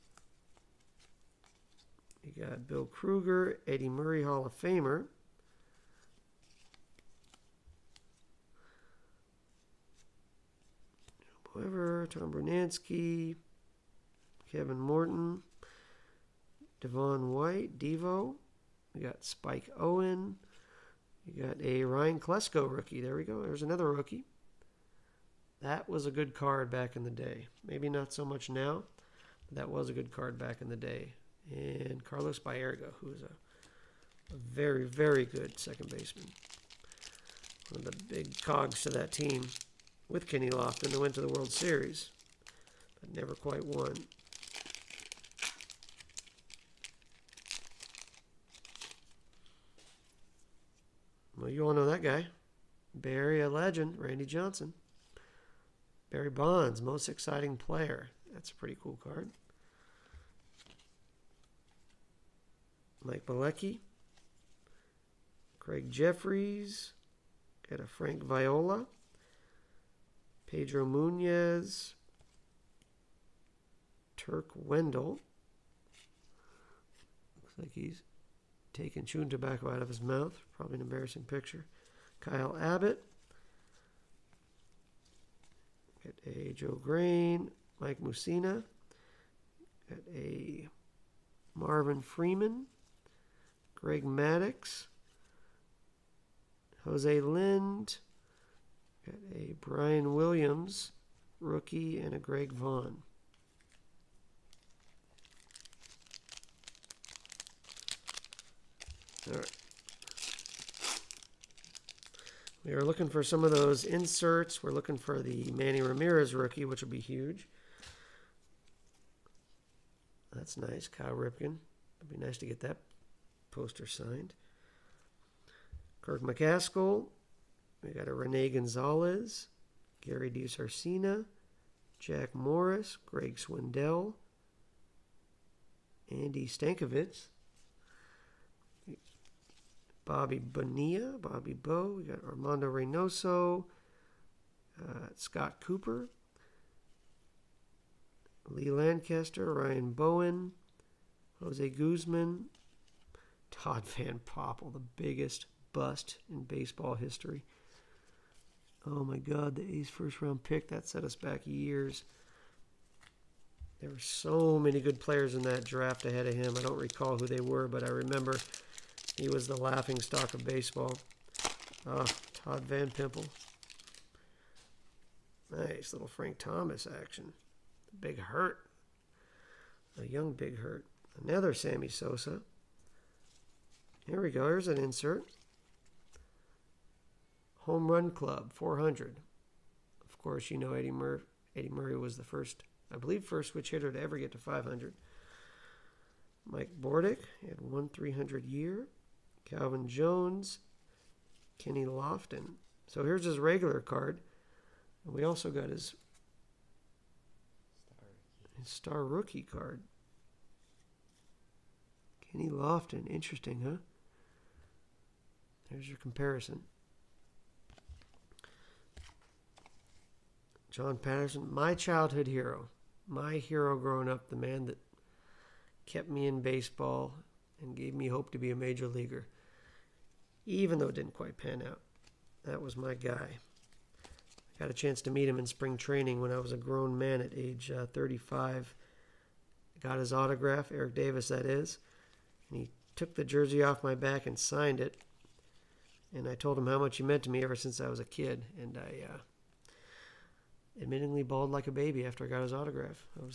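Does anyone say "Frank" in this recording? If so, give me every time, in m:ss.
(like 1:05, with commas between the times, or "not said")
1:07, 2:56.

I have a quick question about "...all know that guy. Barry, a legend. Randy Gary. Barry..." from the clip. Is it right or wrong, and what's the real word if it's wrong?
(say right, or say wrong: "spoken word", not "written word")
wrong: "Johnson", not "Gary".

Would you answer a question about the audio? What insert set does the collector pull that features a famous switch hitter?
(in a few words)
Home Run Club 400.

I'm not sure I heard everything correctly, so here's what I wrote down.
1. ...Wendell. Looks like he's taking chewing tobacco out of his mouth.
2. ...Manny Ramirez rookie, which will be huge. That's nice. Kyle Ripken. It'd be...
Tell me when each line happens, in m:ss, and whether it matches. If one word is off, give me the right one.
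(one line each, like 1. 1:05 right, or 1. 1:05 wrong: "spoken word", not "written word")
1. 1:14 right
2. 1:55 right.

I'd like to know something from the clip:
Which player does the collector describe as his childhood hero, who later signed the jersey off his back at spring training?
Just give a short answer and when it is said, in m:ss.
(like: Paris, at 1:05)
Eric Davis, at 4:00.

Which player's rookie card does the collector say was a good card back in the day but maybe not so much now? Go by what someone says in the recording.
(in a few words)
Ryan Klesko.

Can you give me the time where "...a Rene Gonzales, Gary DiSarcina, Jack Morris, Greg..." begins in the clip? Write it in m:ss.
2:08.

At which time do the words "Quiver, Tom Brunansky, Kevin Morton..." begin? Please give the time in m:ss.
0:11.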